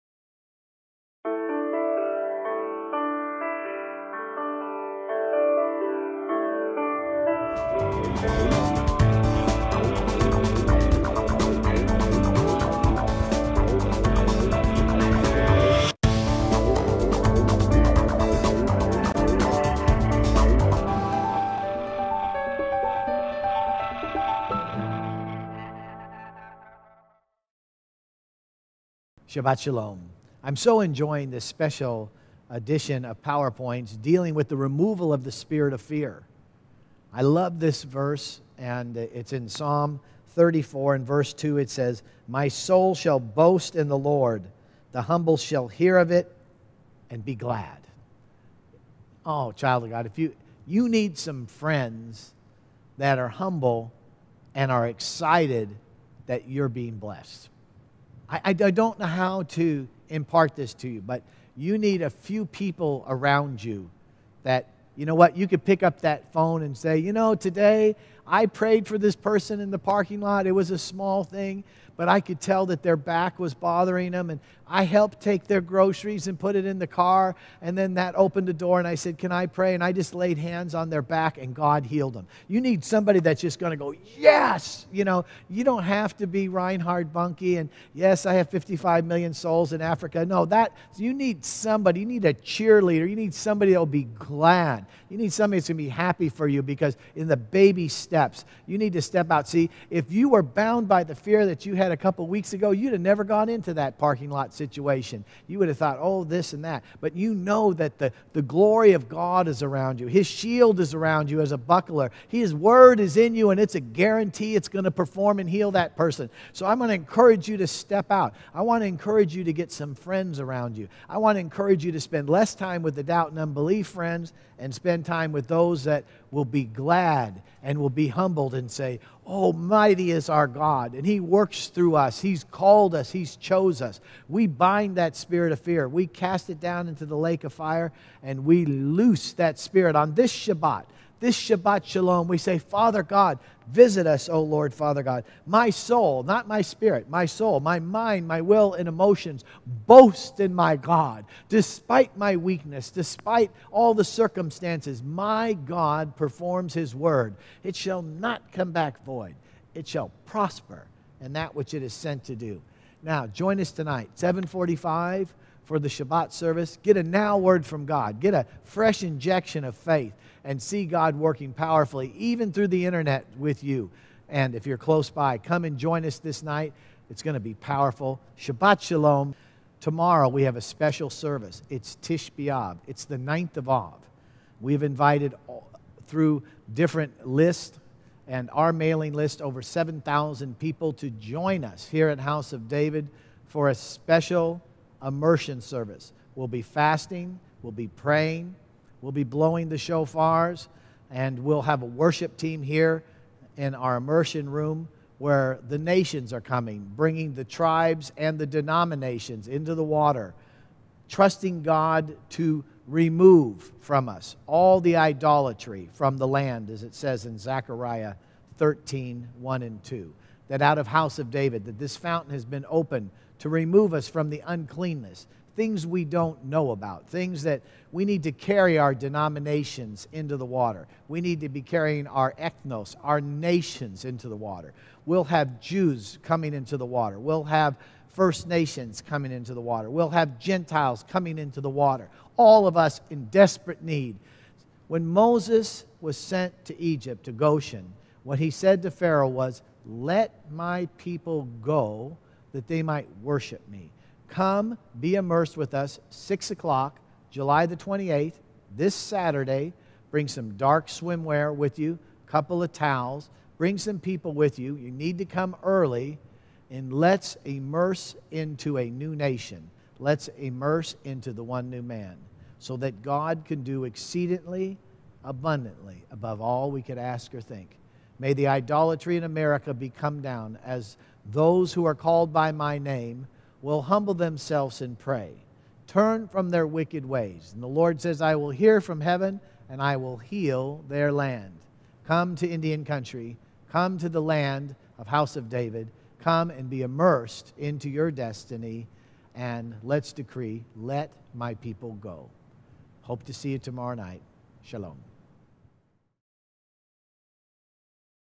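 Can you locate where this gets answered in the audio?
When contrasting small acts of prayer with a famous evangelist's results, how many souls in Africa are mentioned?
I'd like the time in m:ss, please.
1:28.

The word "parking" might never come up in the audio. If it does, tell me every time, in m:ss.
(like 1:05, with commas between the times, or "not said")
1:09, 1:43.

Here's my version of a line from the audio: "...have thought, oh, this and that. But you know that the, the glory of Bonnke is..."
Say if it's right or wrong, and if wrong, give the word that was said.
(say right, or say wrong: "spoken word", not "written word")
wrong: "God", not "Bonnke".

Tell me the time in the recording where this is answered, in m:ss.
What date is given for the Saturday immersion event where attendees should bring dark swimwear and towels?
4:17.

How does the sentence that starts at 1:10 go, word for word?
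It was a small thing, but I could tell that their back was bothering them.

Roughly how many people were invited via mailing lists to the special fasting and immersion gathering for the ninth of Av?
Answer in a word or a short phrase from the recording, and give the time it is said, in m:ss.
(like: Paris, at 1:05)
7,000, at 3:09.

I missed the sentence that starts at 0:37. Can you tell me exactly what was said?
I love this verse, and it's in Psalm 34 and verse 2.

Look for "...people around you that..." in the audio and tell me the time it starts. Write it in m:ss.
1:02.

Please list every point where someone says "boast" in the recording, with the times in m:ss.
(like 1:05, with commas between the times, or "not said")
0:43, 2:29.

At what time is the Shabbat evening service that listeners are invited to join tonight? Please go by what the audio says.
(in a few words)
7:45.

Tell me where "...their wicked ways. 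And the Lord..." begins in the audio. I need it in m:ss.
4:46.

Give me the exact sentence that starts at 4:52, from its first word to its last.
Come to Indian country, come to the land of House of David, come and be immersed into your destiny.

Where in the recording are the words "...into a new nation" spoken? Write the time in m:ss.
4:28.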